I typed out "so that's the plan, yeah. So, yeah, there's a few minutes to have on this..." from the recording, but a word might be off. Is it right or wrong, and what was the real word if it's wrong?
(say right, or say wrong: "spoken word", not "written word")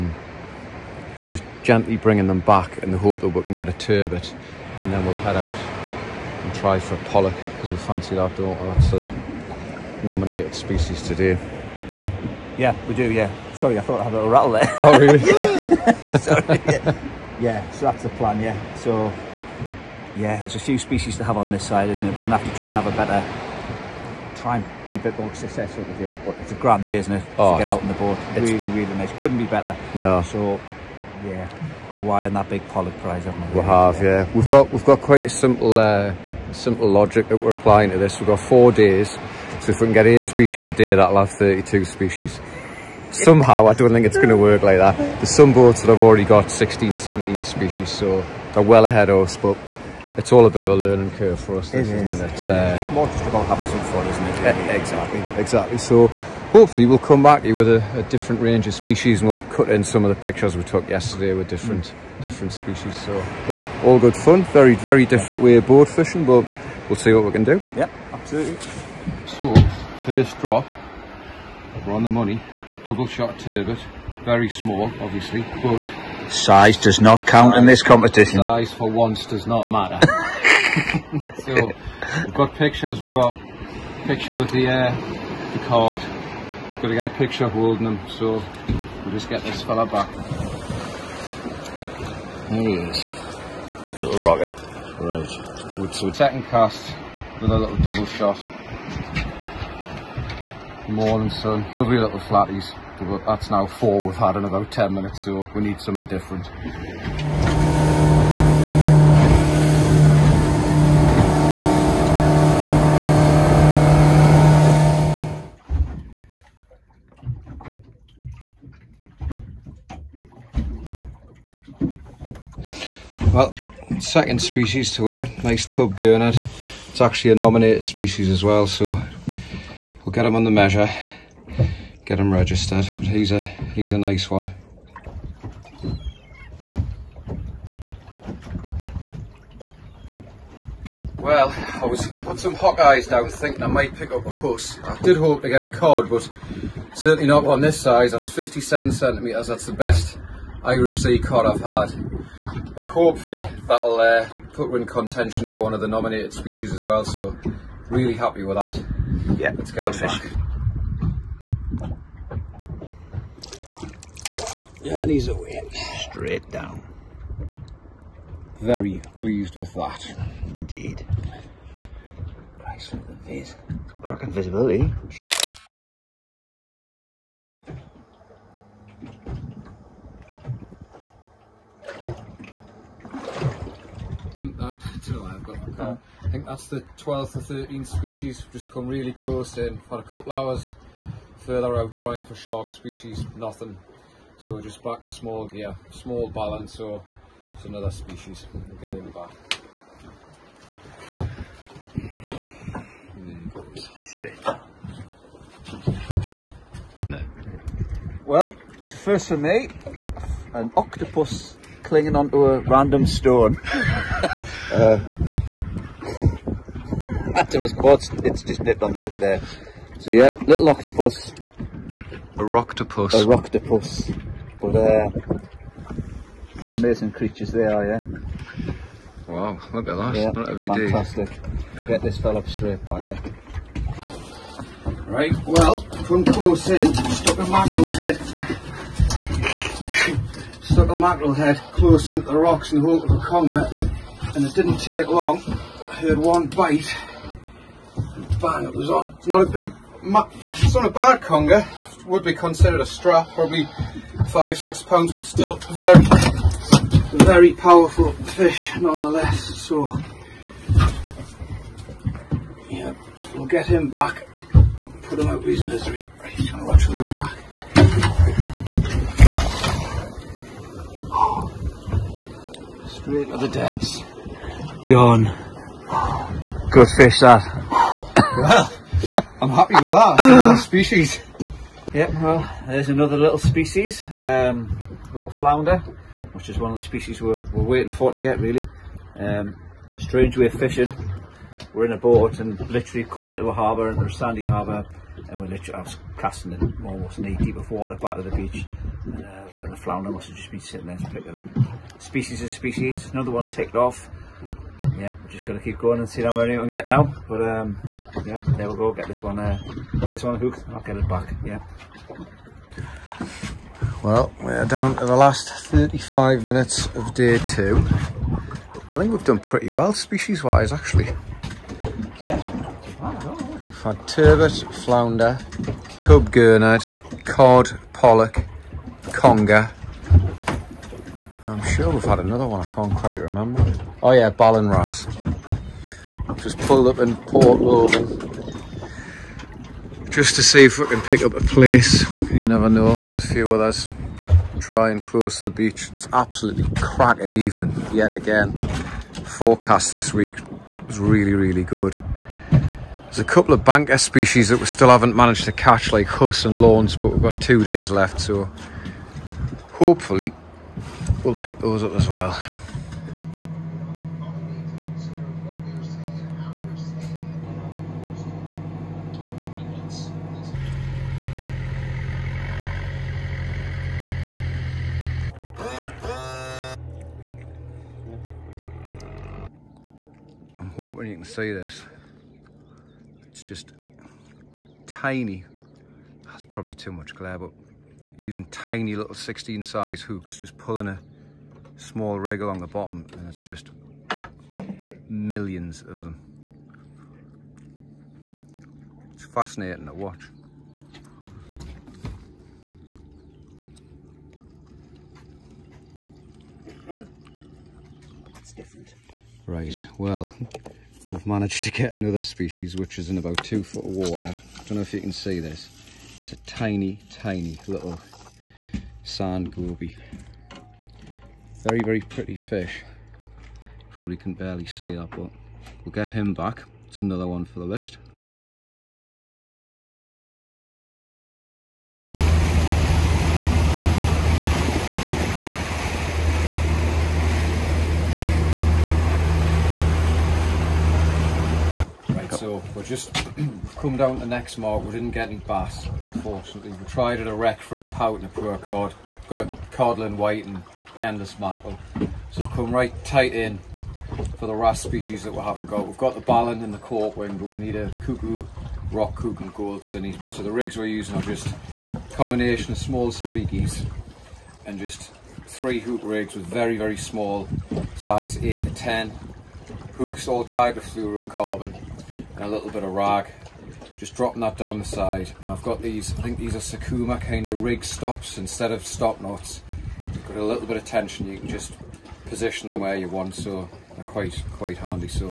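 wrong: "species", not "minutes".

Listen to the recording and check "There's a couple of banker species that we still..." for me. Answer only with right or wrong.
right.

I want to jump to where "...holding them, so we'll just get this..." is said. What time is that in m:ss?
1:27.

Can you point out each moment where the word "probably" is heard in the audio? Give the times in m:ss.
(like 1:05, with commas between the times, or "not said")
4:13, 6:26, 7:03.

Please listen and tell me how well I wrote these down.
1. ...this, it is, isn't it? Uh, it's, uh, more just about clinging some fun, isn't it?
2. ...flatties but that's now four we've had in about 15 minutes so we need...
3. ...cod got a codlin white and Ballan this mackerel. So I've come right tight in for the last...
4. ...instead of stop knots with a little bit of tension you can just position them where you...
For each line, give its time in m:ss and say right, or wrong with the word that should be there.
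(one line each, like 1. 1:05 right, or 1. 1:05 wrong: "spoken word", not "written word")
1. 0:51 wrong: "having", not "clinging"
2. 1:42 wrong: "10", not "15"
3. 7:28 wrong: "Endless", not "Ballan"
4. 7:58 right.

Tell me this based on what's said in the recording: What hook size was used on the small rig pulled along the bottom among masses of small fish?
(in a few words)
16.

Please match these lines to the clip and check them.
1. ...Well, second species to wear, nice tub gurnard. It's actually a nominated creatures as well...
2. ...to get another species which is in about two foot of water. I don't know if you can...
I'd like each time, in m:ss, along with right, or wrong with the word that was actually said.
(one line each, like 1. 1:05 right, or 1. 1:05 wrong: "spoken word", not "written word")
1. 2:03 wrong: "species", not "creatures"
2. 6:51 right.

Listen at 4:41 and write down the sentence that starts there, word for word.
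Yep, well, there's another little species, um, little flounder, which is one of the species we're, we're waiting for to get really.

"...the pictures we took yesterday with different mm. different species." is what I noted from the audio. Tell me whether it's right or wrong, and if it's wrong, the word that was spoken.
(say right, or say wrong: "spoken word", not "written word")
right.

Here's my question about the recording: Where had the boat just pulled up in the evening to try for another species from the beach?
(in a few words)
Port Logan.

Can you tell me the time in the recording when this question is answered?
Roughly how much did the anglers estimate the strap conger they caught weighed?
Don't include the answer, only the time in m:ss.
4:14.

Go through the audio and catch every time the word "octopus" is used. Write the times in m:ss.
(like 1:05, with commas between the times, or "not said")
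3:30, 3:40.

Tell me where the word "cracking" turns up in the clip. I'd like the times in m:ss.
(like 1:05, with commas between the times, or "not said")
2:54, 5:46.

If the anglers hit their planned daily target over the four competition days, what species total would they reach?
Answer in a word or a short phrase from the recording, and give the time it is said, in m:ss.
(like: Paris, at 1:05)
32, at 0:41.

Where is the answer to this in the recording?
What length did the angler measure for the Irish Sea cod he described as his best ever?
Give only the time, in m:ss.
2:28.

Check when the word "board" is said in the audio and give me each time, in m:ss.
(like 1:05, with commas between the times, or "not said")
1:05.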